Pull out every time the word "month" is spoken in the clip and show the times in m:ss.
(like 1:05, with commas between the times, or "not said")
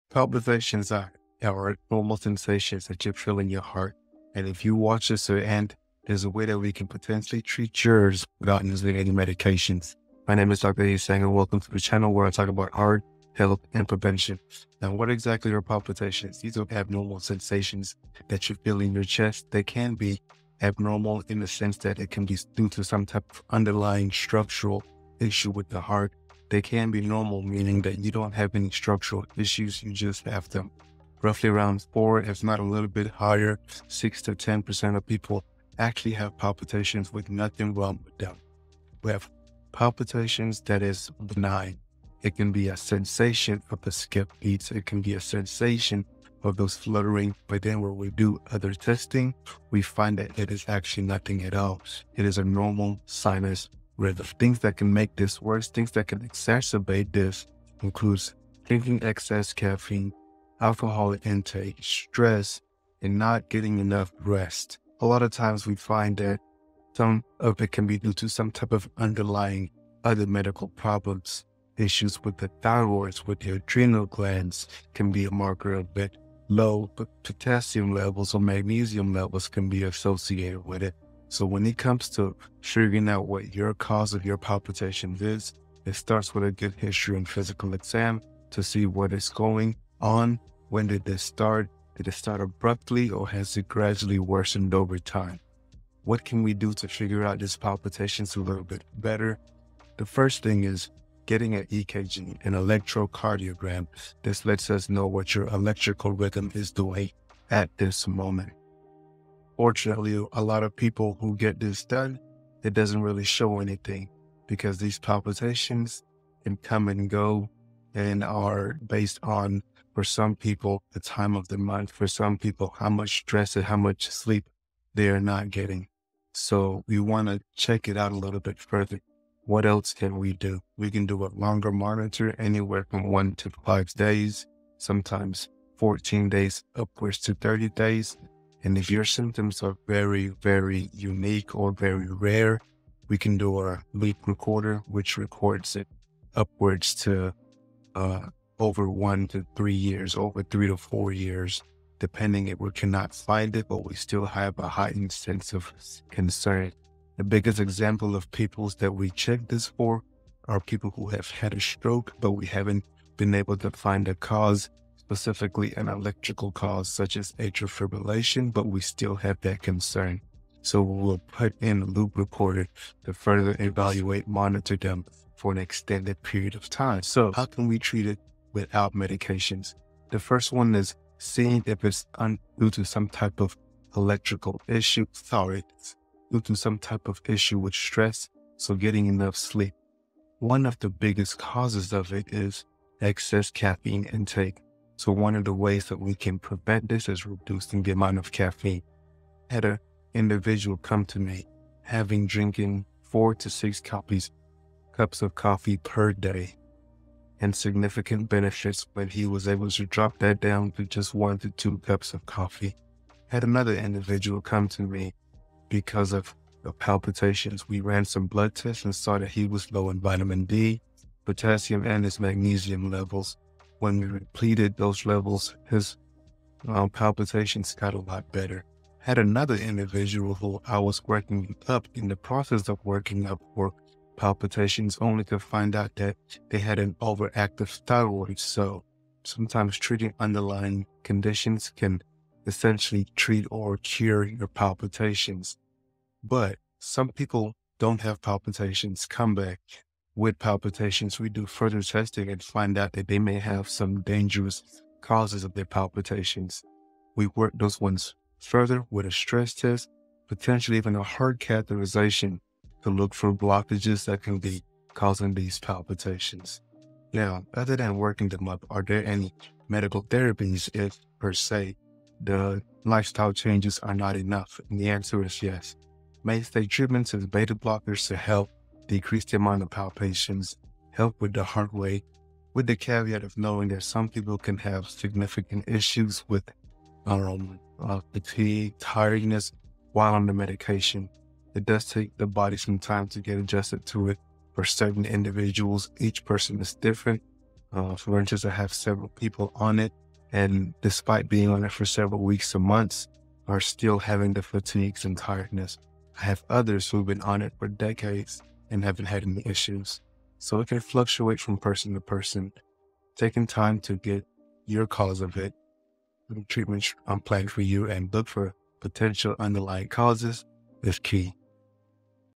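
2:01, 5:02.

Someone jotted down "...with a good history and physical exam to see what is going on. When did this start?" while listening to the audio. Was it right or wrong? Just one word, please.
right.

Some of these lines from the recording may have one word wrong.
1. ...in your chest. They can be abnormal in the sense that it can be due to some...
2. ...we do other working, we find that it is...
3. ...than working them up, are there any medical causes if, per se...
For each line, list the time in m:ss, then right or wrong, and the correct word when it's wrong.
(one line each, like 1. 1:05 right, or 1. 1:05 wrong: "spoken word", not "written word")
1. 0:18 right
2. 0:47 wrong: "testing", not "working"
3. 4:27 wrong: "therapies", not "causes".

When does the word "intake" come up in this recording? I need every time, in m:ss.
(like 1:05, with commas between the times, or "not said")
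1:01, 3:14.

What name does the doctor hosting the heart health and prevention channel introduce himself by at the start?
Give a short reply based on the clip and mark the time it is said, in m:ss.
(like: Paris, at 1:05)
Dr. Isang, at 0:10.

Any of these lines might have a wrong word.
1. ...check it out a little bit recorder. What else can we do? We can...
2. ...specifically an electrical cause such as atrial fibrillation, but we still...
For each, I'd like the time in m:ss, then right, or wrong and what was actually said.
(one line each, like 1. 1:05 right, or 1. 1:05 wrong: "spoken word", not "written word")
1. 2:07 wrong: "further", not "recorder"
2. 2:45 right.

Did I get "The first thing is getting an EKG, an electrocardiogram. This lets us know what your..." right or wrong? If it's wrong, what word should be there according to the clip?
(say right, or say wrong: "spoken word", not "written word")
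right.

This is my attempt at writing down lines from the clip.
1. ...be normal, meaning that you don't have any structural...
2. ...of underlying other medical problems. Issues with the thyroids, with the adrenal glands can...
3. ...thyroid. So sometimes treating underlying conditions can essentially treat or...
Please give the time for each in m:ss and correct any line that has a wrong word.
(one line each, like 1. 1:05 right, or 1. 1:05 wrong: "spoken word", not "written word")
1. 0:26 right
2. 1:08 right
3. 3:57 right.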